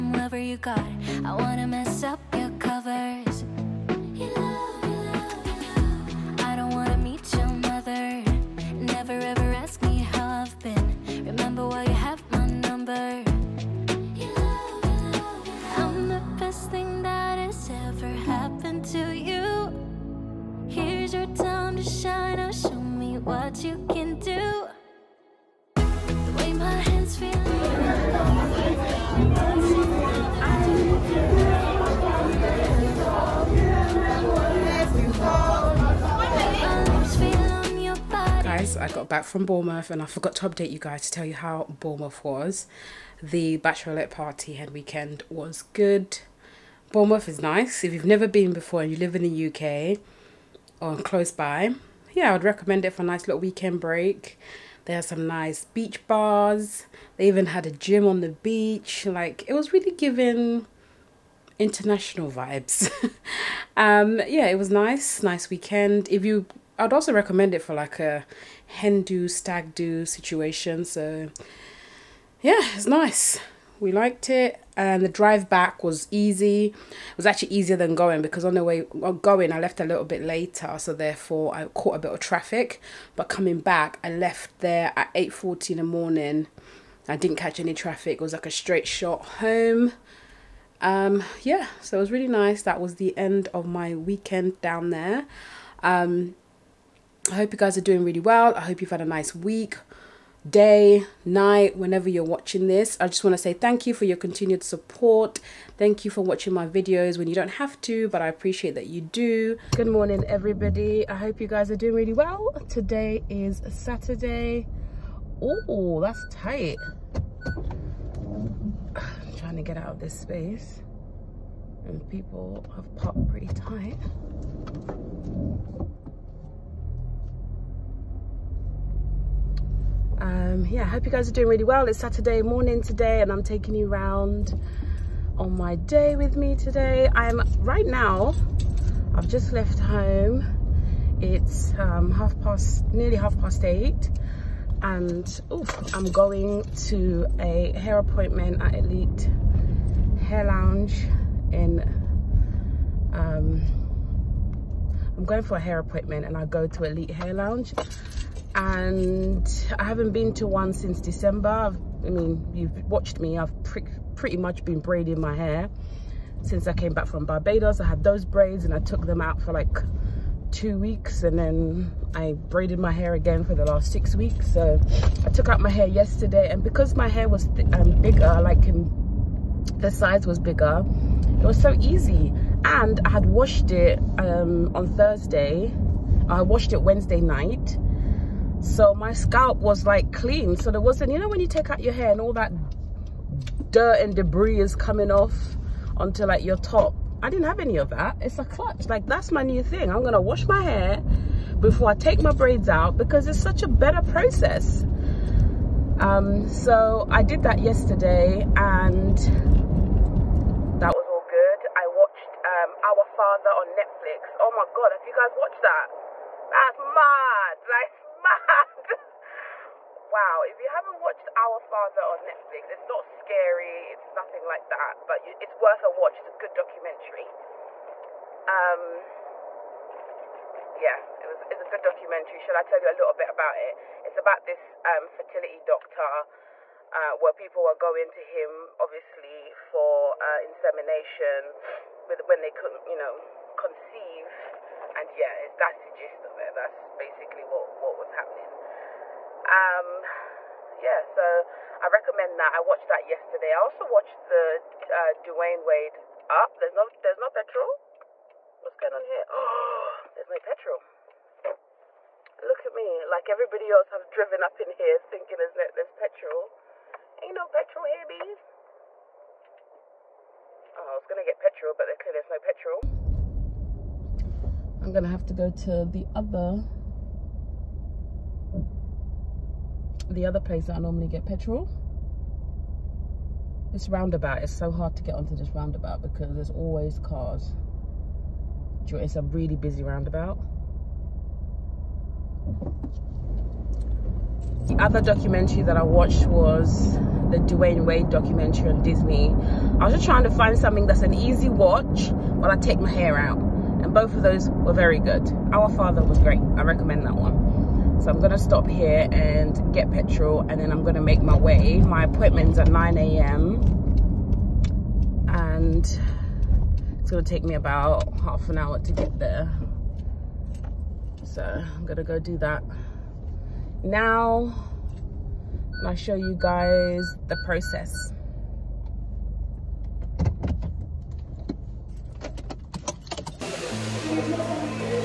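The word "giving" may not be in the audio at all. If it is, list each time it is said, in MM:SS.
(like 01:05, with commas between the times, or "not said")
00:59.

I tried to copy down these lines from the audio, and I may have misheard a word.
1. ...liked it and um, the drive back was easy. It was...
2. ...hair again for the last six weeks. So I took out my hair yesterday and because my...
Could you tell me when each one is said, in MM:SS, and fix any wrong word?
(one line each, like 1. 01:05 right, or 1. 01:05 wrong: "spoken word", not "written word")
1. 01:13 right
2. 02:52 right.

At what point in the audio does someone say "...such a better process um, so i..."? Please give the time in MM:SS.
03:23.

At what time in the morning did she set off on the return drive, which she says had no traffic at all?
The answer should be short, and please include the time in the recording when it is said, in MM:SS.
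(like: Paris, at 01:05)
8:40, at 01:25.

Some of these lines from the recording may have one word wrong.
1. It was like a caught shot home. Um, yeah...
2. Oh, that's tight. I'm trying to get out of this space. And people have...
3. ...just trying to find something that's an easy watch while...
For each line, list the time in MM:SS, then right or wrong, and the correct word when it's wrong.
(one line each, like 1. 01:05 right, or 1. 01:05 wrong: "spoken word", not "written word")
1. 01:28 wrong: "straight", not "caught"
2. 01:55 right
3. 04:59 right.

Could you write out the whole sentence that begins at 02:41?
I've, i mean, you've watched me.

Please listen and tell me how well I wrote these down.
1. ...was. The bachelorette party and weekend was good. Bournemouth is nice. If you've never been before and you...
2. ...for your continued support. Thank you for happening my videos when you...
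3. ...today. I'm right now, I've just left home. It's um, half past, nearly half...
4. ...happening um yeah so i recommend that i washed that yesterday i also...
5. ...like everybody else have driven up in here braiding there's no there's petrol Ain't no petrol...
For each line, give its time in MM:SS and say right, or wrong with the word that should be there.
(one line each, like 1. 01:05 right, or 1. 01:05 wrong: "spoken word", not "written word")
1. 00:42 right
2. 01:43 wrong: "watching", not "happening"
3. 02:16 right
4. 04:08 wrong: "watched", not "washed"
5. 04:23 wrong: "thinking", not "braiding".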